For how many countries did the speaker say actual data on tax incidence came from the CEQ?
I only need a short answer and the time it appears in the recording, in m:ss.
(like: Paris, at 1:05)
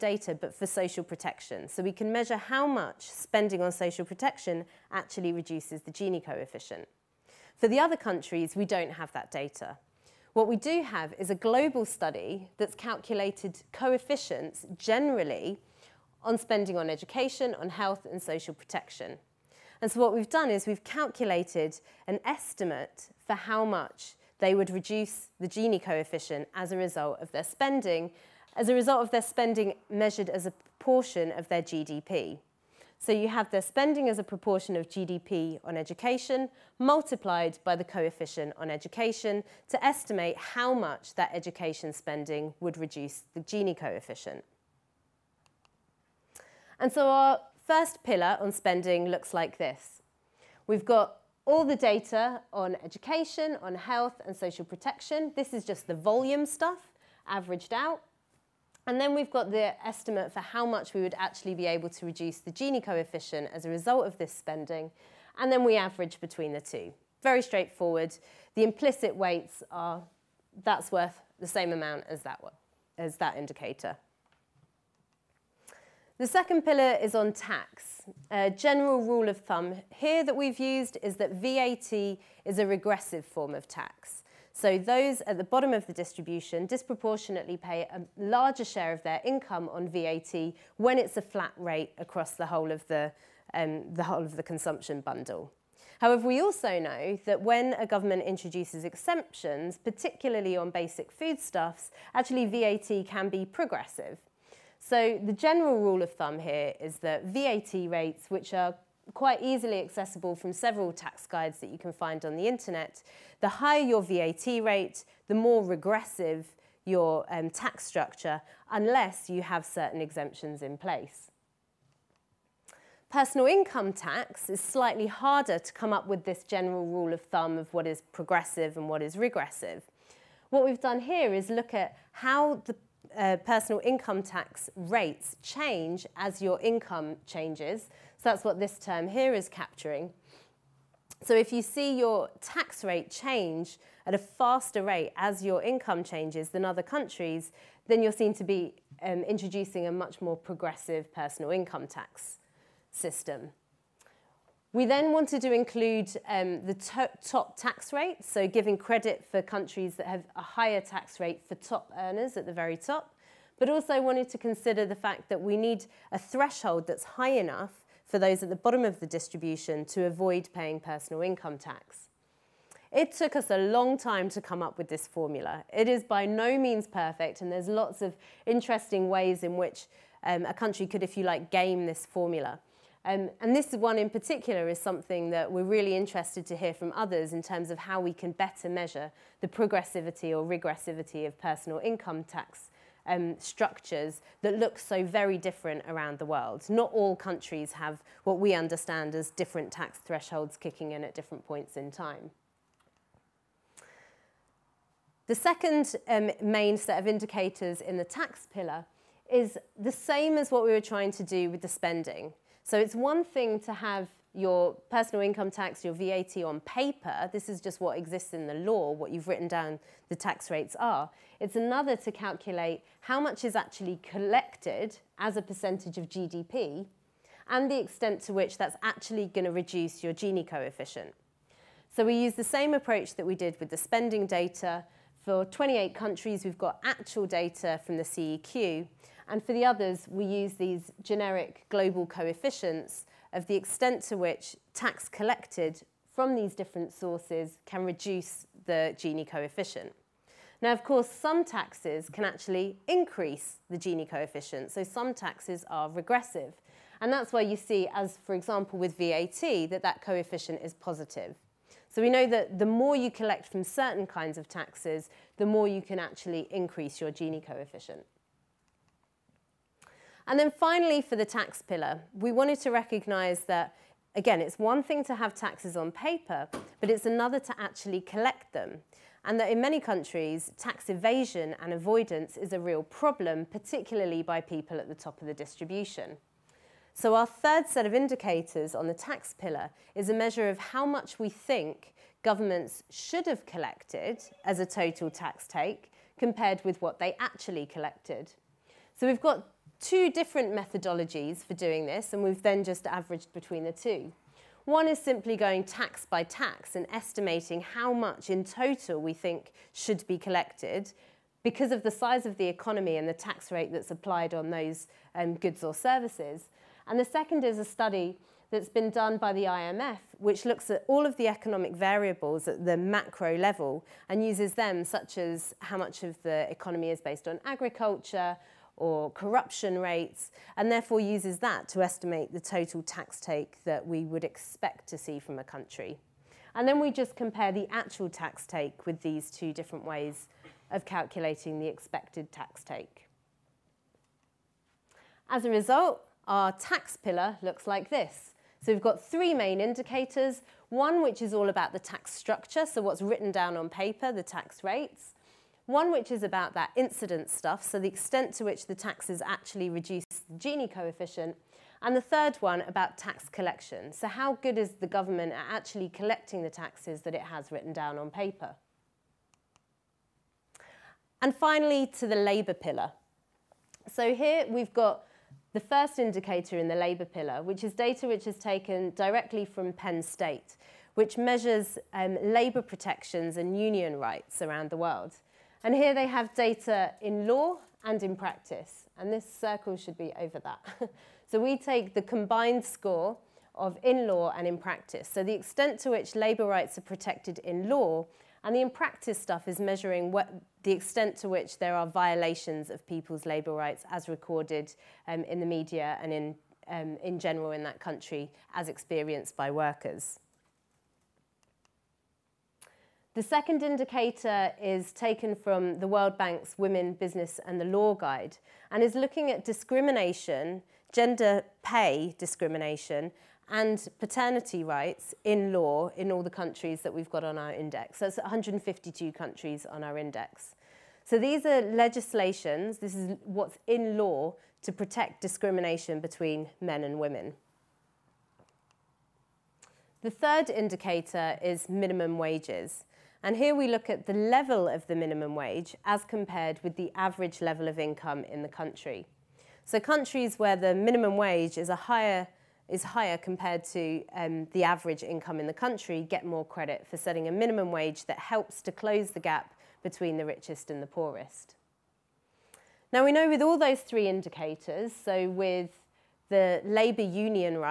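28, at 3:55.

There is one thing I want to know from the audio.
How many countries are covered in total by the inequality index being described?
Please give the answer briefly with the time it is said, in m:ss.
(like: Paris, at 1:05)
152, at 7:08.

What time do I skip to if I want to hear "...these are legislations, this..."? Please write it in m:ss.
7:11.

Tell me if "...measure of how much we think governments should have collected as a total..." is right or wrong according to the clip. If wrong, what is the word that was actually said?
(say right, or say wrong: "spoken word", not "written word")
right.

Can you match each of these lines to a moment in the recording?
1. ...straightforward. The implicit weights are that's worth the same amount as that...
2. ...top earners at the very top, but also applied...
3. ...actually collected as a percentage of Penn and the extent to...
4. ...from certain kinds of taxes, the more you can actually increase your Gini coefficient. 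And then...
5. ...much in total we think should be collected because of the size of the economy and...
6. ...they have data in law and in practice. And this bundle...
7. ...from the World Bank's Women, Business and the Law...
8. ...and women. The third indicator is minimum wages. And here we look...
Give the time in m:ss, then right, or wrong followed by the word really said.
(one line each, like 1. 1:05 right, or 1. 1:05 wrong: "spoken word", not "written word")
1. 1:07 right
2. 2:41 wrong: "wanted", not "applied"
3. 3:43 wrong: "GDP", not "Penn"
4. 4:23 right
5. 5:07 right
6. 6:25 wrong: "circle", not "bundle"
7. 6:55 right
8. 7:16 right.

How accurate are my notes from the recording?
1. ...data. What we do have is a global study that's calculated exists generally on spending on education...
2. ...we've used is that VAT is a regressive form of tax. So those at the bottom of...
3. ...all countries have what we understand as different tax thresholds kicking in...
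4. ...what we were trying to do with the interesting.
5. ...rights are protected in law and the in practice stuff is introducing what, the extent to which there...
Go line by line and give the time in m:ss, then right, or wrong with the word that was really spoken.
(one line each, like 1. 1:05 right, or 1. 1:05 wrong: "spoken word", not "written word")
1. 0:09 wrong: "coefficients", not "exists"
2. 1:20 right
3. 3:16 right
4. 3:30 wrong: "spending", not "interesting"
5. 6:36 wrong: "measuring", not "introducing".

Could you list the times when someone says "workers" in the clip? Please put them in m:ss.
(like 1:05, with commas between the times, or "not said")
6:49.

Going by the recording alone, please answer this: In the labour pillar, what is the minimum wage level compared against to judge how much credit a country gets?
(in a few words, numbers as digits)
Average income.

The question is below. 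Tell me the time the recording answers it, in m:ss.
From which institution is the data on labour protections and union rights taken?
6:19.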